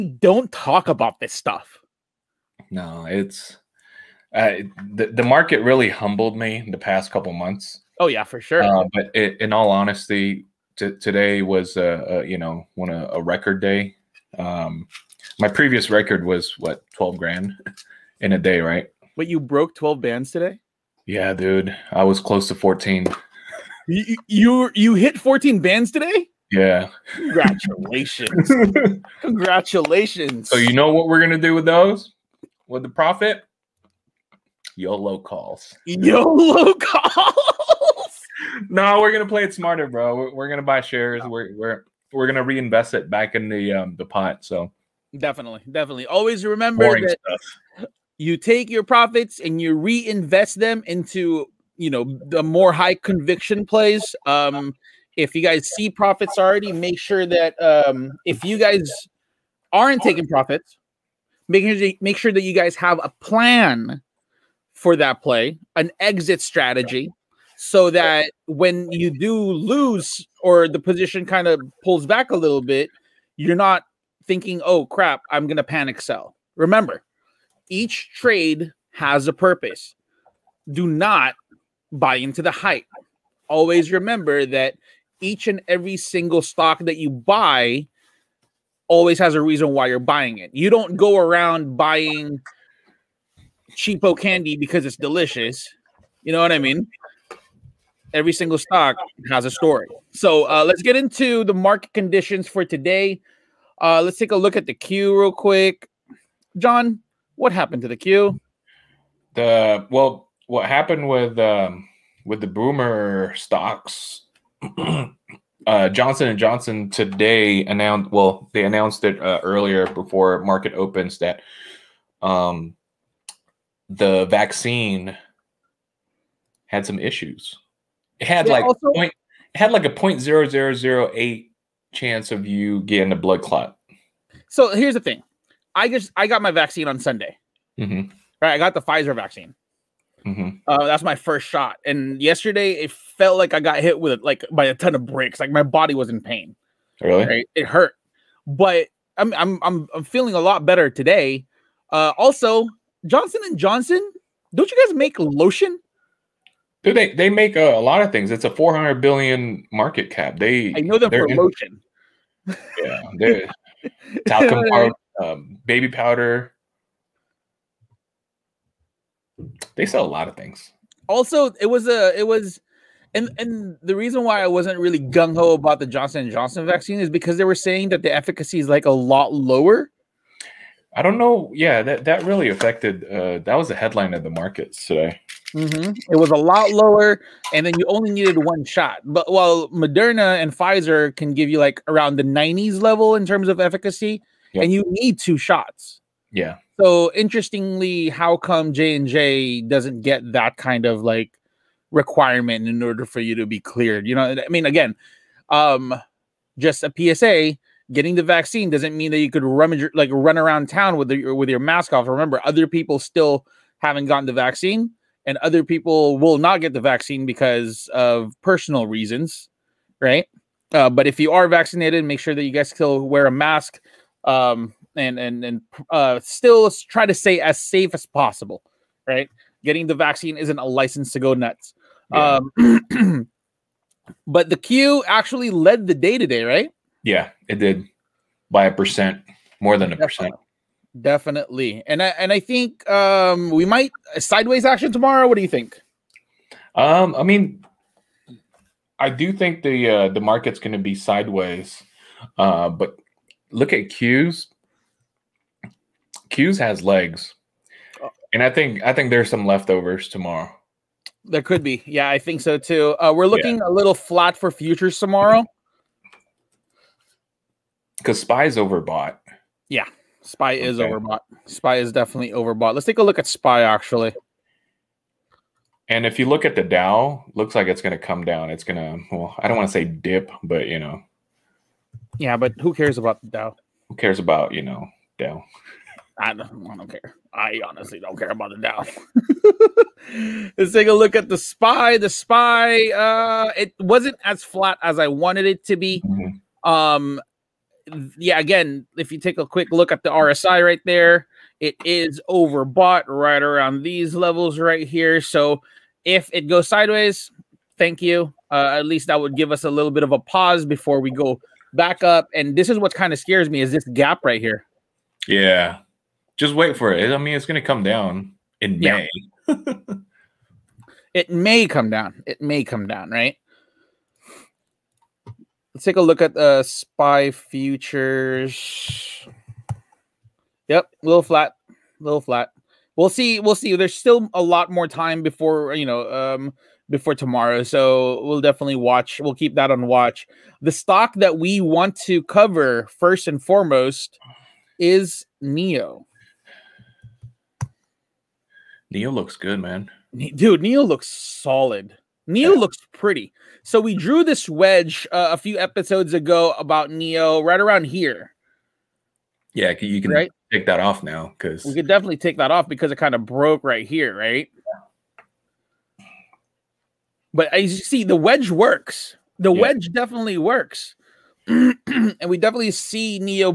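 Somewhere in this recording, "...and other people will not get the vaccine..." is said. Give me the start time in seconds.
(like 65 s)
215 s.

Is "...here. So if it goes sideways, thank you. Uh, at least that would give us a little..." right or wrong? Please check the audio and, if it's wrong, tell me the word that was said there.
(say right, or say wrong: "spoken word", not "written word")
right.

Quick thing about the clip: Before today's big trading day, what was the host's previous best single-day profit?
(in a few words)
12 grand.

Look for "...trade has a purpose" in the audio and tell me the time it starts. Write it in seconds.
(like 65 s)
78 s.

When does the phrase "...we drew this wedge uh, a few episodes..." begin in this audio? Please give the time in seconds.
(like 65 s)
353 s.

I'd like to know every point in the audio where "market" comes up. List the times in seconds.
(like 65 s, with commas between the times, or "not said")
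5 s, 101 s, 120 s, 159 s, 184 s, 250 s.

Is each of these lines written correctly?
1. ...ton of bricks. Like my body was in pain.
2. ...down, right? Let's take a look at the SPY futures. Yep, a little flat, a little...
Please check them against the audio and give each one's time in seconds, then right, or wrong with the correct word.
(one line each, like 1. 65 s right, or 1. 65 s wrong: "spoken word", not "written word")
1. 144 s right
2. 322 s right.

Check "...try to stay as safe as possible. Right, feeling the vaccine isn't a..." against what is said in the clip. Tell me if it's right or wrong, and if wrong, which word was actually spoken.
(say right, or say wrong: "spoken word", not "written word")
wrong: "getting", not "feeling".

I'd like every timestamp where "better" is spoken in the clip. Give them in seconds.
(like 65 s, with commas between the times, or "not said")
150 s.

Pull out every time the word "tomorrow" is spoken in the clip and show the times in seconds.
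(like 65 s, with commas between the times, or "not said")
244 s, 260 s, 264 s, 337 s.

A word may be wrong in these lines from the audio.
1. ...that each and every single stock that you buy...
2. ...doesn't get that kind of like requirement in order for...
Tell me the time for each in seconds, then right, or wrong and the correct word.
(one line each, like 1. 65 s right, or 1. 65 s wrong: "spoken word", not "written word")
1. 84 s right
2. 199 s right.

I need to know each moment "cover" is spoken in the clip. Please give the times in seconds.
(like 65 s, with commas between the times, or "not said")
342 s.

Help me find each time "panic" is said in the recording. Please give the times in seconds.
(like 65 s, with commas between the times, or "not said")
75 s.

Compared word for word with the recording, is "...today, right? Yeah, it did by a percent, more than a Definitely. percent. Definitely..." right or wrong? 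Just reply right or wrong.
right.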